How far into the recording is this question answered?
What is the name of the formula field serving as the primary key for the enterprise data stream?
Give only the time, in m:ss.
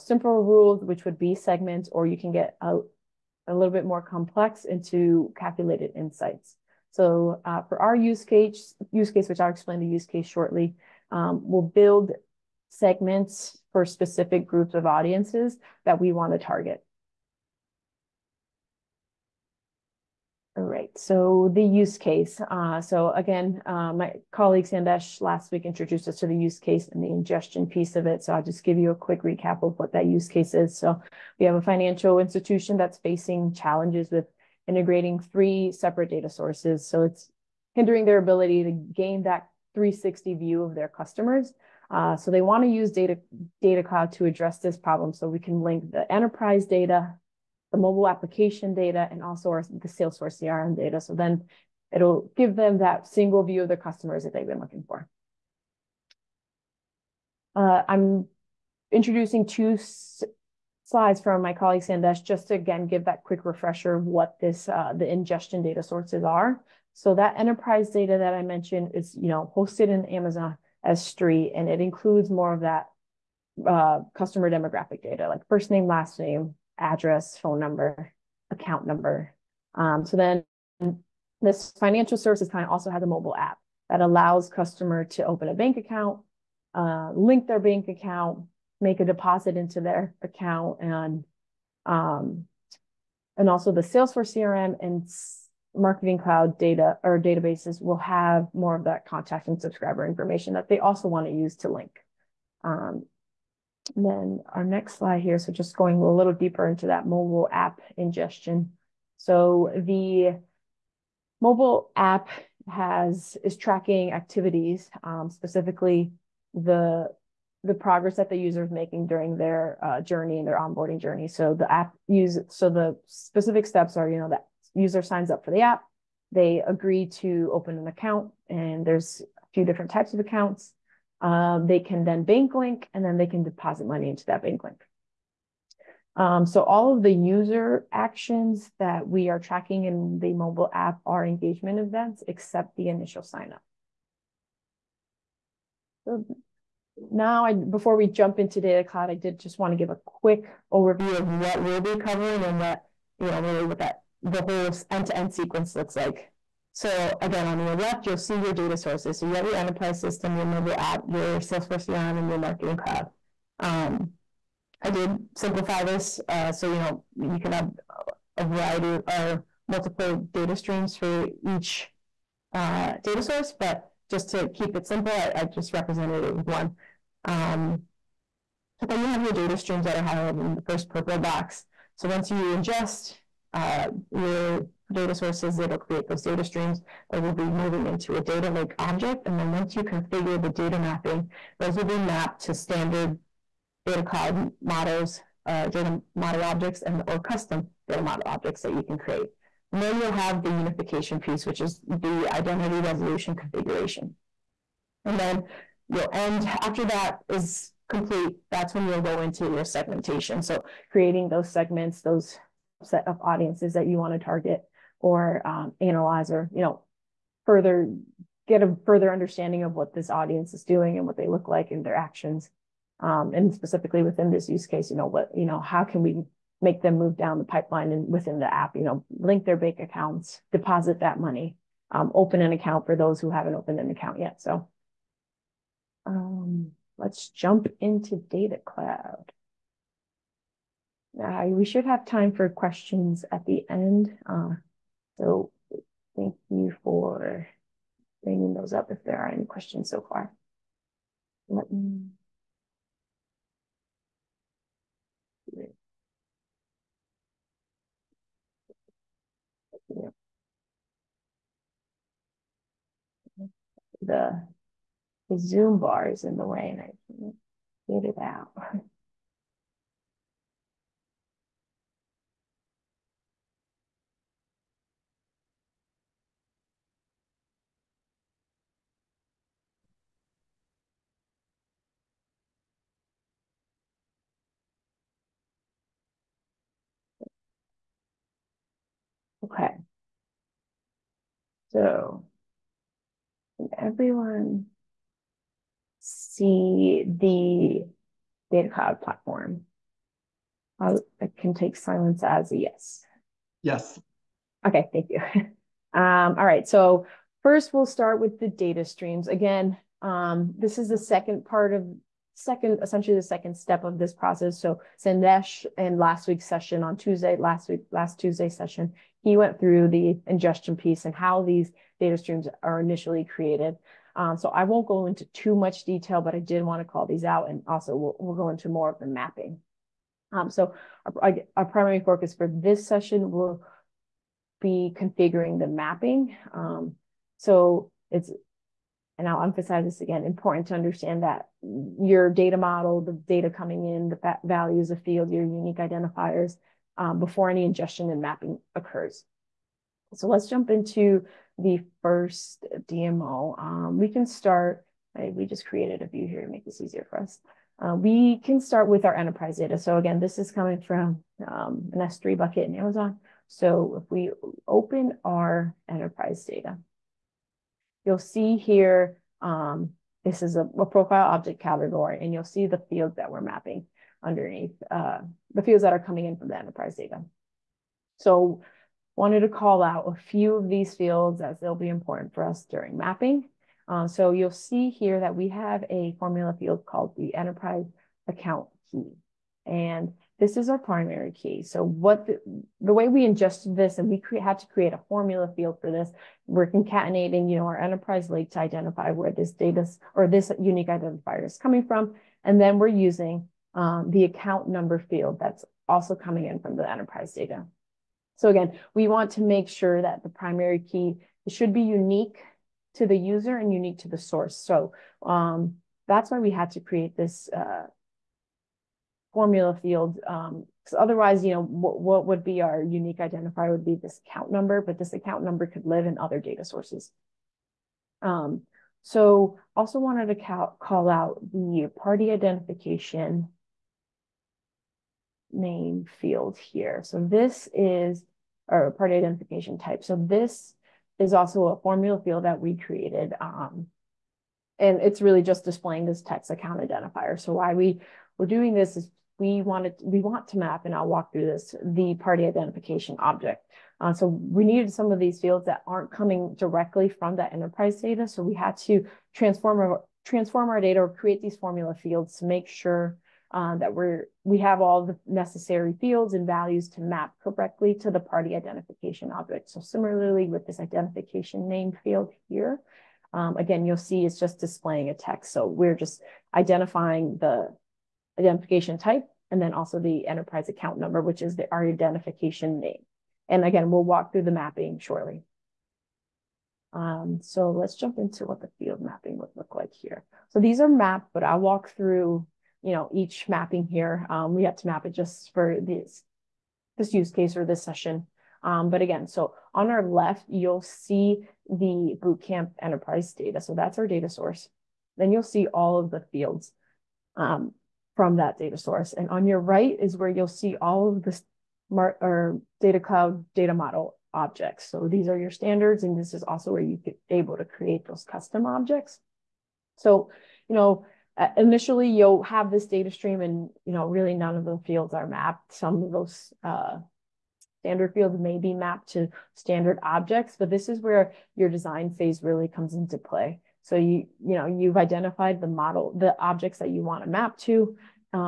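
6:27.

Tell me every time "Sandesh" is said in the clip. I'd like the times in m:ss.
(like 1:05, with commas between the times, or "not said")
0:24, 1:01, 5:15.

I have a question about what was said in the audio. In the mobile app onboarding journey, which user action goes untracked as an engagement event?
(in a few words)
initial sign up.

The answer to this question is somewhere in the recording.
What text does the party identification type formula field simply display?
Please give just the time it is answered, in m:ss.
7:26.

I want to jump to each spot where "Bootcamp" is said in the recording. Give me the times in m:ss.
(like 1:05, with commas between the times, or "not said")
8:22.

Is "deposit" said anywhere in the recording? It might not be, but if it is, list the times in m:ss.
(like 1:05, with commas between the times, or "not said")
1:29, 2:13, 3:50.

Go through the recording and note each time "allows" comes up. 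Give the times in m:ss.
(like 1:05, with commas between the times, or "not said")
1:24.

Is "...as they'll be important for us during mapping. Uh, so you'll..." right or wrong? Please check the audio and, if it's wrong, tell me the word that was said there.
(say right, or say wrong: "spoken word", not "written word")
right.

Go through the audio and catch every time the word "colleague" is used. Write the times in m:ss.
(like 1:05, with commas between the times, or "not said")
0:24, 1:01.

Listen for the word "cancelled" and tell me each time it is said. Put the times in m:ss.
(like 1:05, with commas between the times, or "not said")
not said.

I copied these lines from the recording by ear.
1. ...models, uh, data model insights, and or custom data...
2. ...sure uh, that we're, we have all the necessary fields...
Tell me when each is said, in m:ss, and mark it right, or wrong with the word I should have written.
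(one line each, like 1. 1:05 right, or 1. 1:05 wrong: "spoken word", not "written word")
1. 3:14 wrong: "objects", not "insights"
2. 7:42 right.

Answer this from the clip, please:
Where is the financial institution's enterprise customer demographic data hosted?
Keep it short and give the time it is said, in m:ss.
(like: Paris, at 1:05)
Amazon S3, at 1:10.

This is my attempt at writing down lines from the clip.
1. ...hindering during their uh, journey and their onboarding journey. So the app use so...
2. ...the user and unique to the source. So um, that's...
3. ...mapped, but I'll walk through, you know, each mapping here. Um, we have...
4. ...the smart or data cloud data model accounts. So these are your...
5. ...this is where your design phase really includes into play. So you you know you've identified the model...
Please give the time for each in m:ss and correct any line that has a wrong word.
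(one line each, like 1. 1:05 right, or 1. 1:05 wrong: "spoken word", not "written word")
1. 1:58 wrong: "making", not "hindering"
2. 6:53 right
3. 8:10 right
4. 8:31 wrong: "objects", not "accounts"
5. 8:50 wrong: "comes", not "includes".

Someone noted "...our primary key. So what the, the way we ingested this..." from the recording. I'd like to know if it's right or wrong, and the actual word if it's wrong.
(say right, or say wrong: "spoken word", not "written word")
right.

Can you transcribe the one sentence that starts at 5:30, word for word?
Um, so our, our, primary focus for this session will be configuring the mapping.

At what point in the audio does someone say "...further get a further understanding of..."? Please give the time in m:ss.
3:37.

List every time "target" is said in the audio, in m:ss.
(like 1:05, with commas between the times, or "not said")
0:16, 3:34.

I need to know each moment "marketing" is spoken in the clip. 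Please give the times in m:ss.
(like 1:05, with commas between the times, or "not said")
1:35, 2:42.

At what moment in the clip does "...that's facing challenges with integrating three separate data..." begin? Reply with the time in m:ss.
0:32.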